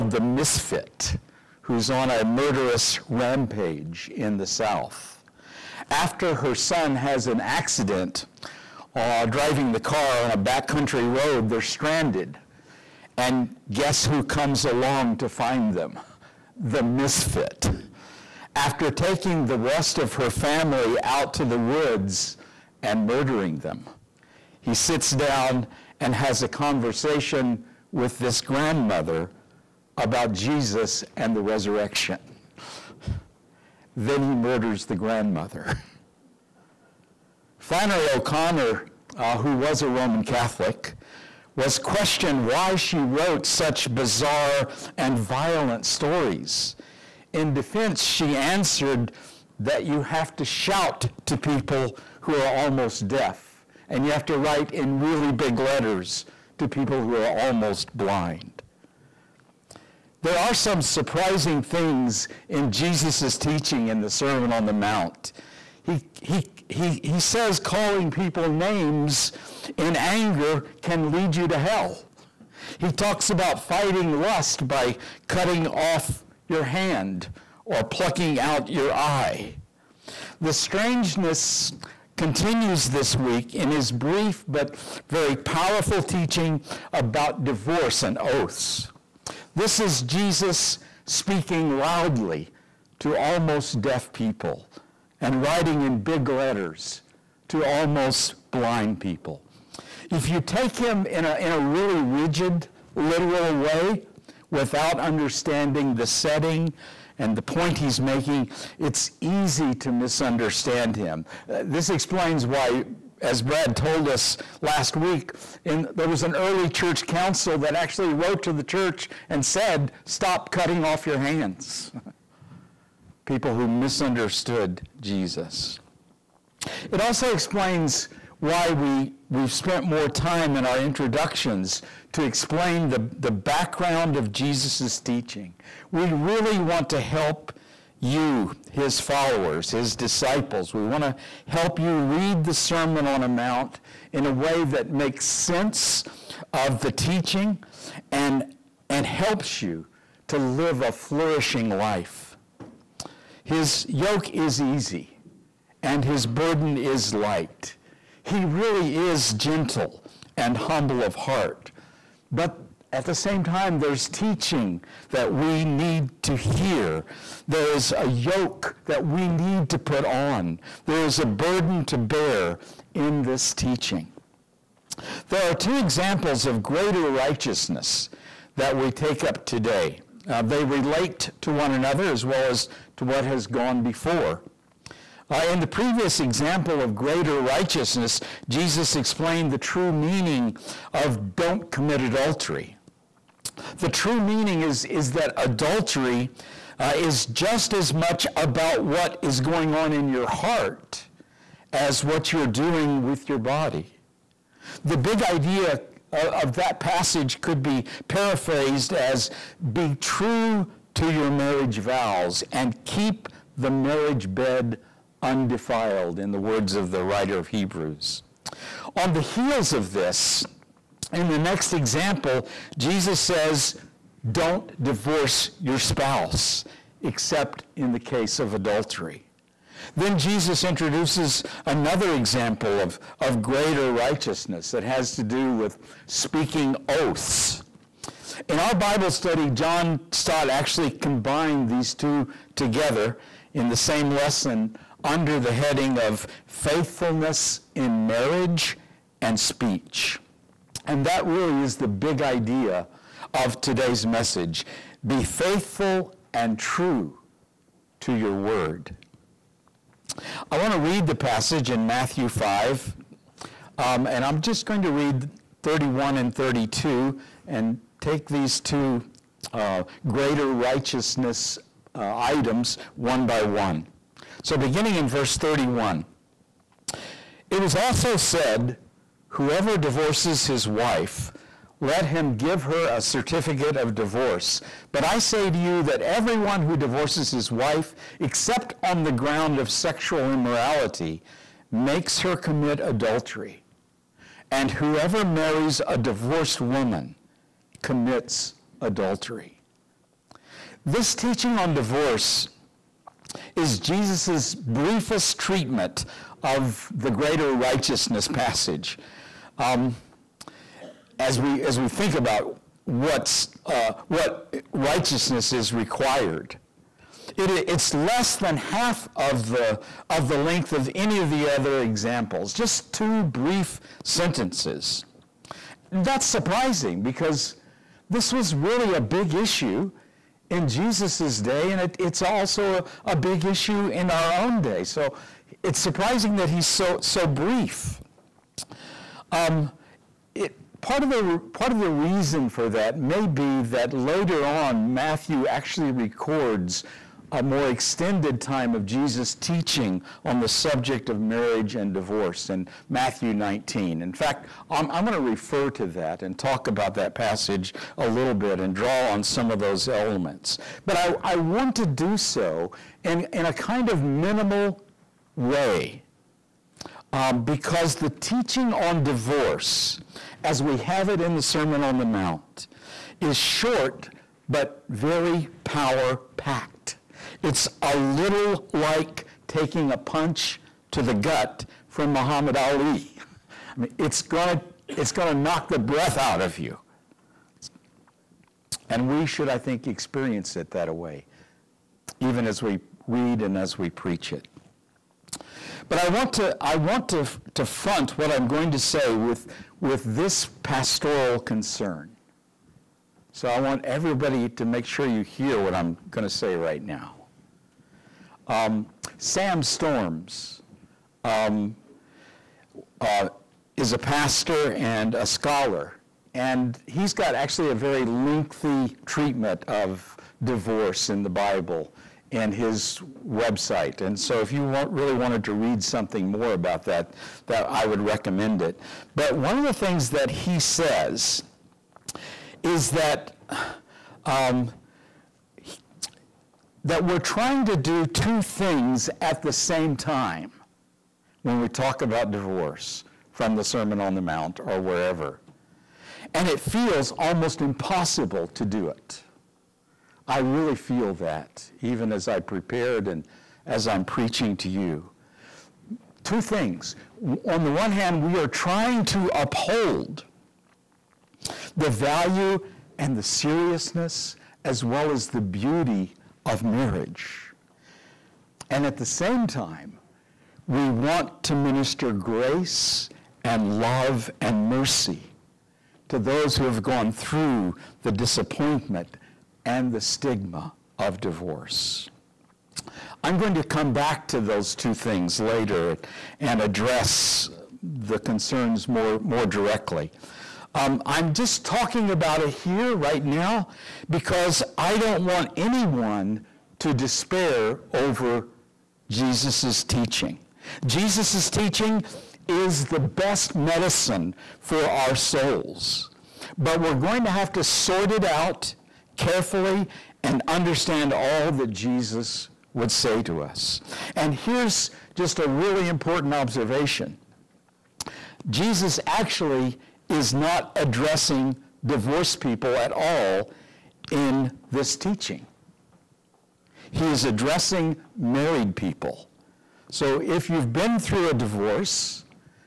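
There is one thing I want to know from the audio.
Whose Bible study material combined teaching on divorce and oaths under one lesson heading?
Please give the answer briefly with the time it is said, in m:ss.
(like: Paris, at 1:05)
John Stott, at 3:59.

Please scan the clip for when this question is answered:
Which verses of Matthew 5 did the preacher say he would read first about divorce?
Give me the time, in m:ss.
4:25.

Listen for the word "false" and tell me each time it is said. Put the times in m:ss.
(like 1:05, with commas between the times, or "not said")
not said.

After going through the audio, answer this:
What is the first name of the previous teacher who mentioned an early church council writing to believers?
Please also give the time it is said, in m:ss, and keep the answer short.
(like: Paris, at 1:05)
Brad, at 1:53.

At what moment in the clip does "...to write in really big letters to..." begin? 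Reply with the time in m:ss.
0:54.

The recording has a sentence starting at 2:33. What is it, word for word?
His yoke is easy and his burden is light.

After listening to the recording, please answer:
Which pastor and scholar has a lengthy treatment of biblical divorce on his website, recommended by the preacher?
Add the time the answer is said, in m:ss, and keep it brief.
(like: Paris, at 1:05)
Sam Storms, at 6:49.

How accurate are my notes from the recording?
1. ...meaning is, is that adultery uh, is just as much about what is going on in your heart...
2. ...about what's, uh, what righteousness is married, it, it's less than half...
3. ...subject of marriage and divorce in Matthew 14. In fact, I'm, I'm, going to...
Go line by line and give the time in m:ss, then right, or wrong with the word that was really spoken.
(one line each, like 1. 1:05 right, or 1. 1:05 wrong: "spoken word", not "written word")
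1. 3:14 right
2. 5:12 wrong: "required", not "married"
3. 5:50 wrong: "19", not "14".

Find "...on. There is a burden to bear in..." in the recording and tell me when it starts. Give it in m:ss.
2:50.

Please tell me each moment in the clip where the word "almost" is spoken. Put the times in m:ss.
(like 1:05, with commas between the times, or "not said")
0:52, 0:57, 1:33, 1:37, 7:27.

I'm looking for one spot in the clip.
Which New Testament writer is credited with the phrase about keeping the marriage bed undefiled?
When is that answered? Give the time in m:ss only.
3:36.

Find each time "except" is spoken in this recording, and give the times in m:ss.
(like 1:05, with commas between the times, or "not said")
3:47, 4:48.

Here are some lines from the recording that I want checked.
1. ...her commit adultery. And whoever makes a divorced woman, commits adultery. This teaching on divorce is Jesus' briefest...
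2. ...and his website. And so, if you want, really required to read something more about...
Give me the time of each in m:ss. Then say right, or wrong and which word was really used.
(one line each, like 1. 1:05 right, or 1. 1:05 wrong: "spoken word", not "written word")
1. 4:52 wrong: "marries", not "makes"
2. 7:02 wrong: "wanted", not "required".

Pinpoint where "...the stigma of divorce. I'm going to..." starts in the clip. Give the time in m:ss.
7:59.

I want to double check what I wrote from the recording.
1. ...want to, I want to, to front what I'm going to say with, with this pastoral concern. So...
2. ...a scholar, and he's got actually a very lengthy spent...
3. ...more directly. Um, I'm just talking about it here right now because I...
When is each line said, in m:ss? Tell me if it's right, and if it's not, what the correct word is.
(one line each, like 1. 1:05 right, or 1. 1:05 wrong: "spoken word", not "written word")
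1. 6:36 right
2. 6:55 wrong: "treatment", not "spent"
3. 8:09 right.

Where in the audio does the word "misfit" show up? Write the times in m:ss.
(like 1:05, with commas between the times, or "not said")
0:00, 0:16.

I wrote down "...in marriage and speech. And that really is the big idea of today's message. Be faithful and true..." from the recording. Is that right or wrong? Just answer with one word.
right.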